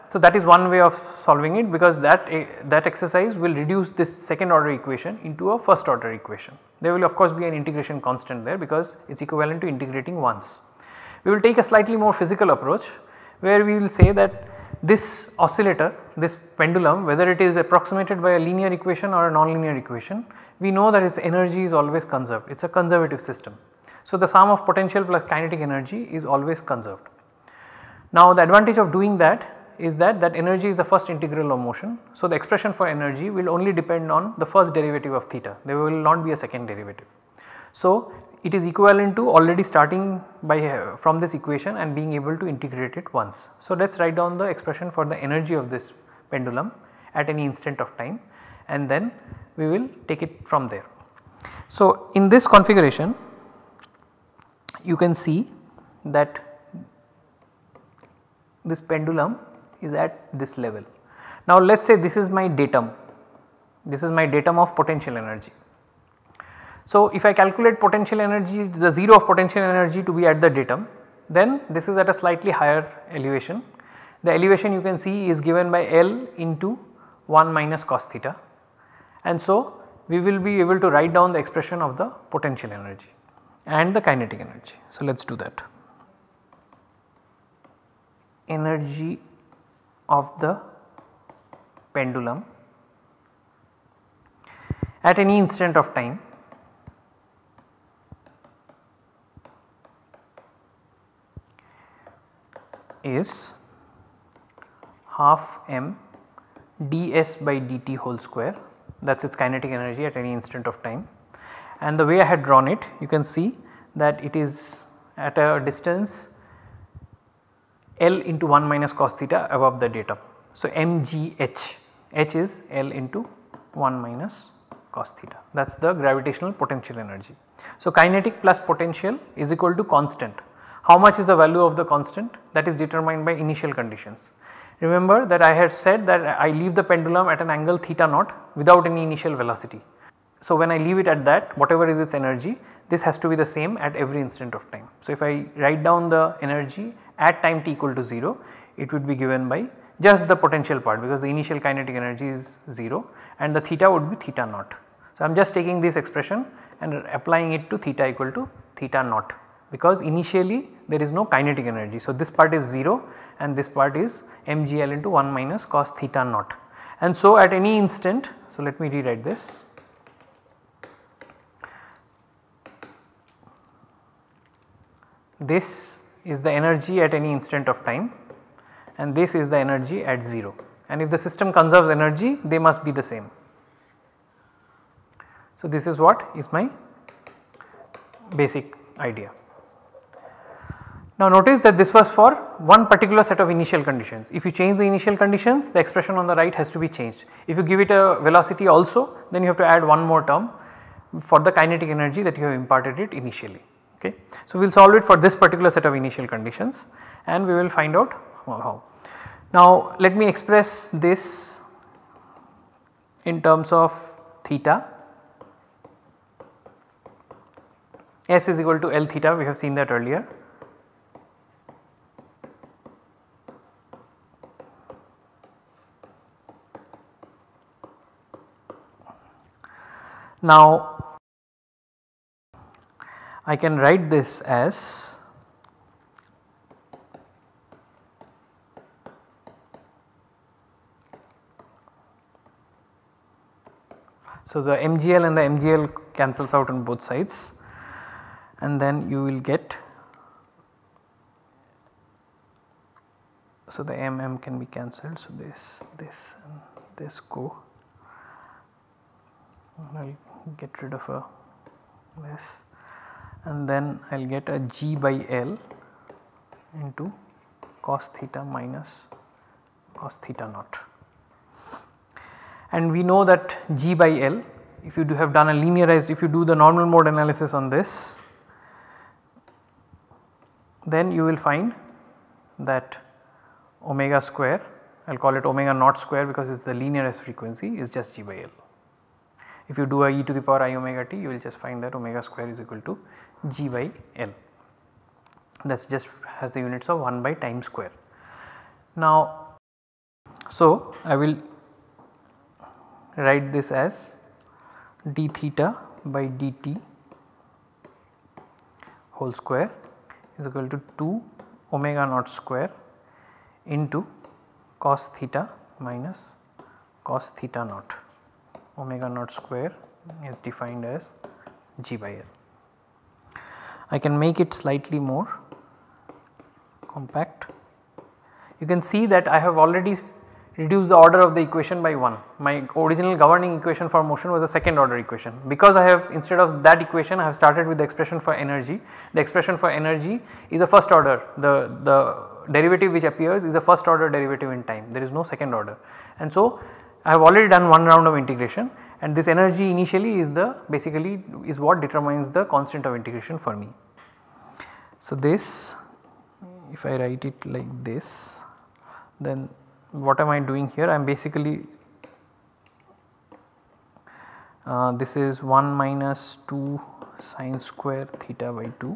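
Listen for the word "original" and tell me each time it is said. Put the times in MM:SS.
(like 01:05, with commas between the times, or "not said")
05:32.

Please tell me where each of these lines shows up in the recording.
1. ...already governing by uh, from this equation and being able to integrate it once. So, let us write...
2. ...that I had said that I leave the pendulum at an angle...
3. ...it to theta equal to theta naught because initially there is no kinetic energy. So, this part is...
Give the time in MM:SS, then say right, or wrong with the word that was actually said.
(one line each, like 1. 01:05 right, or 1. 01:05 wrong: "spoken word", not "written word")
1. 00:39 wrong: "starting", not "governing"
2. 02:15 right
3. 02:37 right.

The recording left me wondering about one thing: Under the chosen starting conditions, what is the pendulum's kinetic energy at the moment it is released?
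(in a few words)
0.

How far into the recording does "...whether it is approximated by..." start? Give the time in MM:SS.
00:17.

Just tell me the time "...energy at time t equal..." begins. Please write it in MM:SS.
02:26.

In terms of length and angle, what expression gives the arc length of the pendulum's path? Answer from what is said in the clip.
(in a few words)
L theta.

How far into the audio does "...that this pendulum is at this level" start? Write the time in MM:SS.
00:56.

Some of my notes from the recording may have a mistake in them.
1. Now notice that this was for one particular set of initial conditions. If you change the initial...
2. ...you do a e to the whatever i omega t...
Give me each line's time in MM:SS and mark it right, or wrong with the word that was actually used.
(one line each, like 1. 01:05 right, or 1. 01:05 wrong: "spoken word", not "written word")
1. 03:11 right
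2. 04:49 wrong: "power", not "whatever".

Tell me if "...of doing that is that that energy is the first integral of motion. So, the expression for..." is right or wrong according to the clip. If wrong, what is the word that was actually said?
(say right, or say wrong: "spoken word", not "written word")
right.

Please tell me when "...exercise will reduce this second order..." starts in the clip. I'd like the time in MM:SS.
00:02.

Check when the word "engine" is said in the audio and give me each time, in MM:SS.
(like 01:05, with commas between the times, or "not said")
not said.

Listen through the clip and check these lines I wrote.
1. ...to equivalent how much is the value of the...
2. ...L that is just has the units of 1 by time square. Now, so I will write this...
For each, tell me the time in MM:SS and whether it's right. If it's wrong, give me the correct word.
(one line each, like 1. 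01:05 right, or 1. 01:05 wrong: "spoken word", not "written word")
1. 02:09 wrong: "constant", not "equivalent"
2. 04:54 right.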